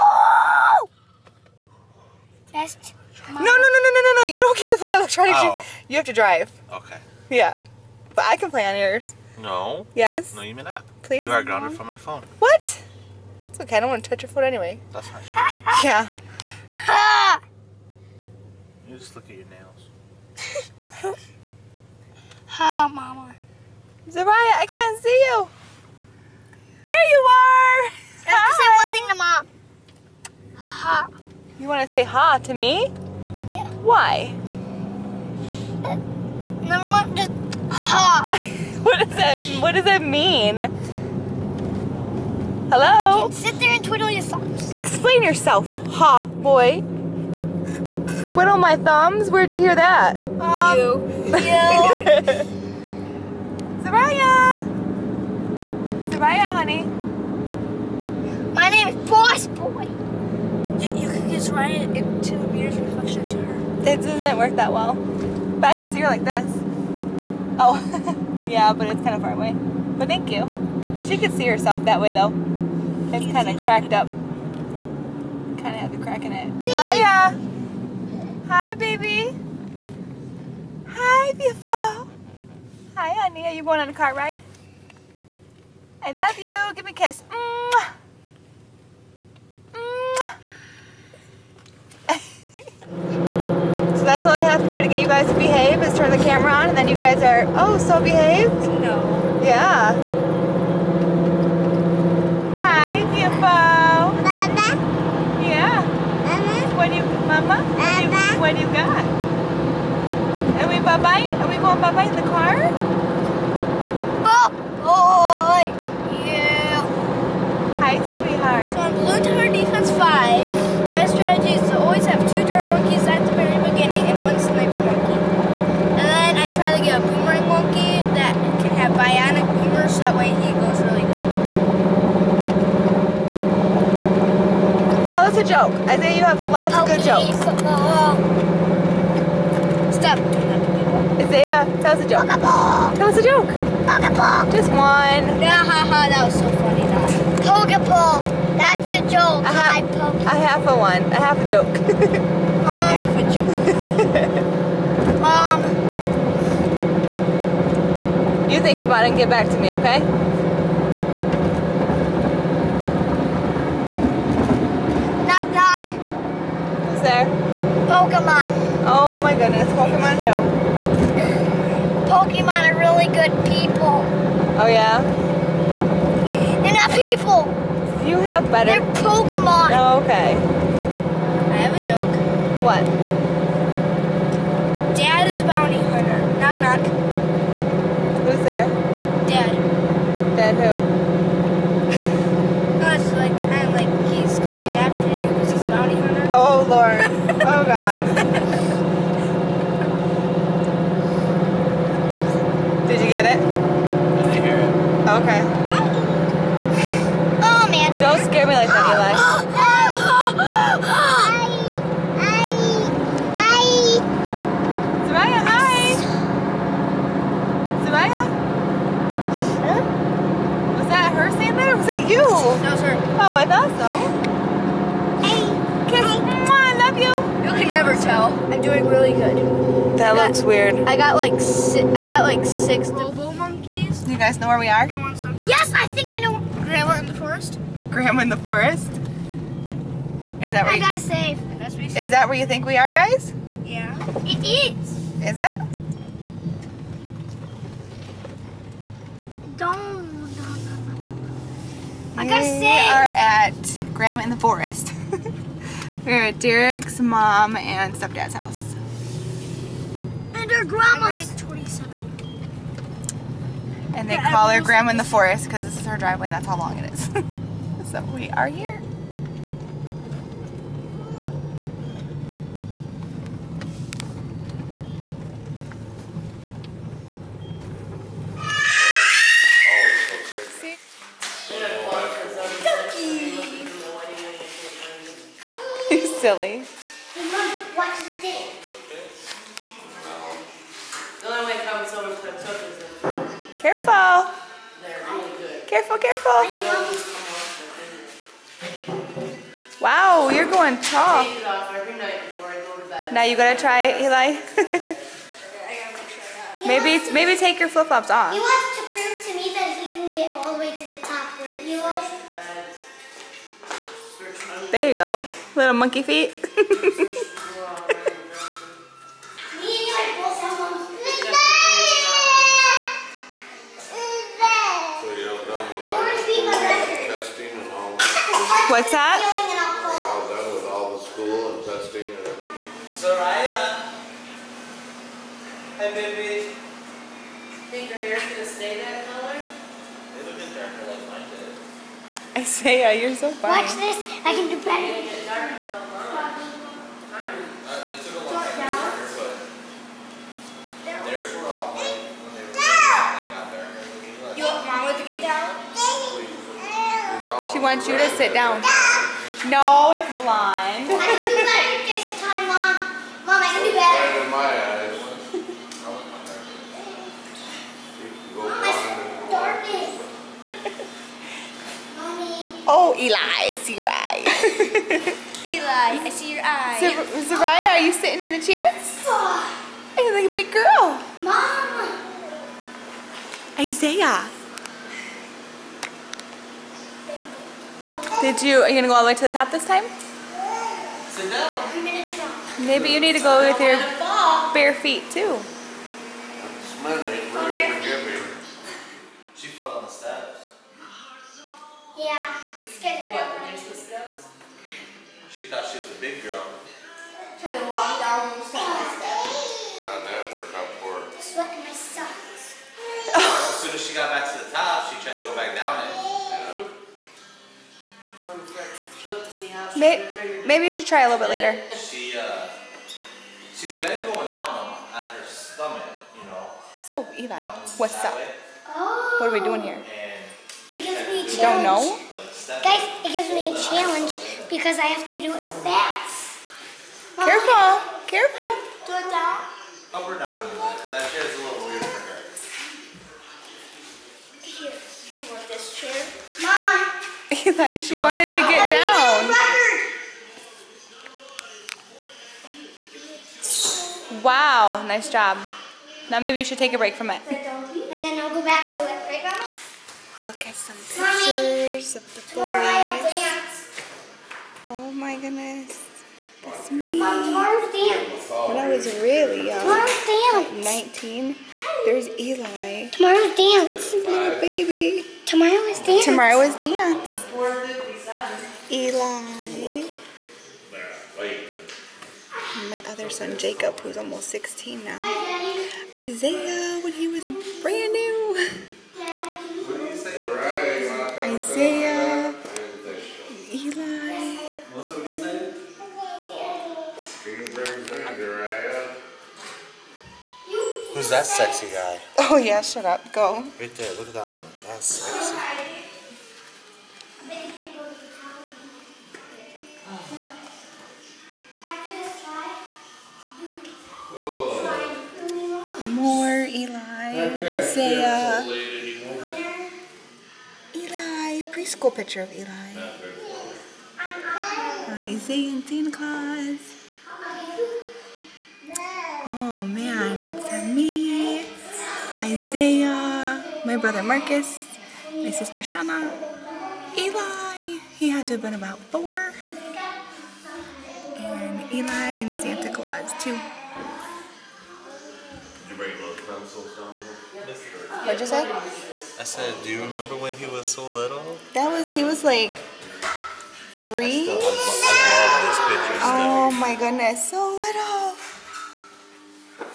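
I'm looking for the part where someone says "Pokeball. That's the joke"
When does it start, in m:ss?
2:27.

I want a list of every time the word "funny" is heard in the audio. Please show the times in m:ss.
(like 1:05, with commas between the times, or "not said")
2:26, 5:43.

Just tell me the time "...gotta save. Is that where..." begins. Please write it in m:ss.
4:00.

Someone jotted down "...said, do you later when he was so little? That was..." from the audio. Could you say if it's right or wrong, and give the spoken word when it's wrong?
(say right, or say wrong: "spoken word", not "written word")
wrong: "remember", not "later".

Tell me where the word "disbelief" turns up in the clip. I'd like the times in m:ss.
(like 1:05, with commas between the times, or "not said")
not said.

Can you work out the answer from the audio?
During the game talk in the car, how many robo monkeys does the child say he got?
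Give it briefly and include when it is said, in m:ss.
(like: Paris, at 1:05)
6, at 3:52.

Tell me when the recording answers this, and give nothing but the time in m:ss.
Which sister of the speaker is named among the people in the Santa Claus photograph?
8:55.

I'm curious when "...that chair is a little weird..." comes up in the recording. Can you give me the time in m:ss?
7:20.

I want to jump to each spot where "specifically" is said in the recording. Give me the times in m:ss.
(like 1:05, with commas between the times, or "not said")
not said.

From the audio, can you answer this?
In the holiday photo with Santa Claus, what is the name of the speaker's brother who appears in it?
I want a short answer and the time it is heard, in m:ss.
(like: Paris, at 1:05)
Marcus, at 8:54.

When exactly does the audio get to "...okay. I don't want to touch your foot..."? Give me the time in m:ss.
0:13.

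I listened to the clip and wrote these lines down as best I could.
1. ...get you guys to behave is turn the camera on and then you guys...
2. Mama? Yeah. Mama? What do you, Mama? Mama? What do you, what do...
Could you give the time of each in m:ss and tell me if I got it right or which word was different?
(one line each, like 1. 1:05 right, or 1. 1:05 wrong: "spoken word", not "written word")
1. 1:34 right
2. 1:44 right.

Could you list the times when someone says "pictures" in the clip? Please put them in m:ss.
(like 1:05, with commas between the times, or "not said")
7:40, 8:41.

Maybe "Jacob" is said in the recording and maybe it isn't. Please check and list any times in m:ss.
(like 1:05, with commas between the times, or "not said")
8:03.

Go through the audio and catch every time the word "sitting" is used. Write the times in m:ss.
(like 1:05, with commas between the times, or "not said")
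6:17.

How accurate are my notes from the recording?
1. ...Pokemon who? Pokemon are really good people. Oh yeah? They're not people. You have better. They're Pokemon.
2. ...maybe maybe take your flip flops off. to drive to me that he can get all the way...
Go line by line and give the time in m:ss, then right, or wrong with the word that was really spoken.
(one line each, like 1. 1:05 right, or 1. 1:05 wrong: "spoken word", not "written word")
1. 2:49 right
2. 5:06 wrong: "prove", not "drive".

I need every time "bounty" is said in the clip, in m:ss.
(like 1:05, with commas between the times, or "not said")
3:05, 3:15.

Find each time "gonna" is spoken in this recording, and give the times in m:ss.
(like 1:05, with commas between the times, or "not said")
5:38, 6:28.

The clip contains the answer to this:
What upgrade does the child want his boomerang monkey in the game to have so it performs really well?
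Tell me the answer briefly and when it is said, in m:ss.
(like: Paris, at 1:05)
bionic boomers, at 2:08.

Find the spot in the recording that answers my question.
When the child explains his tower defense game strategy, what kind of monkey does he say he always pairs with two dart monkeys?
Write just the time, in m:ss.
2:04.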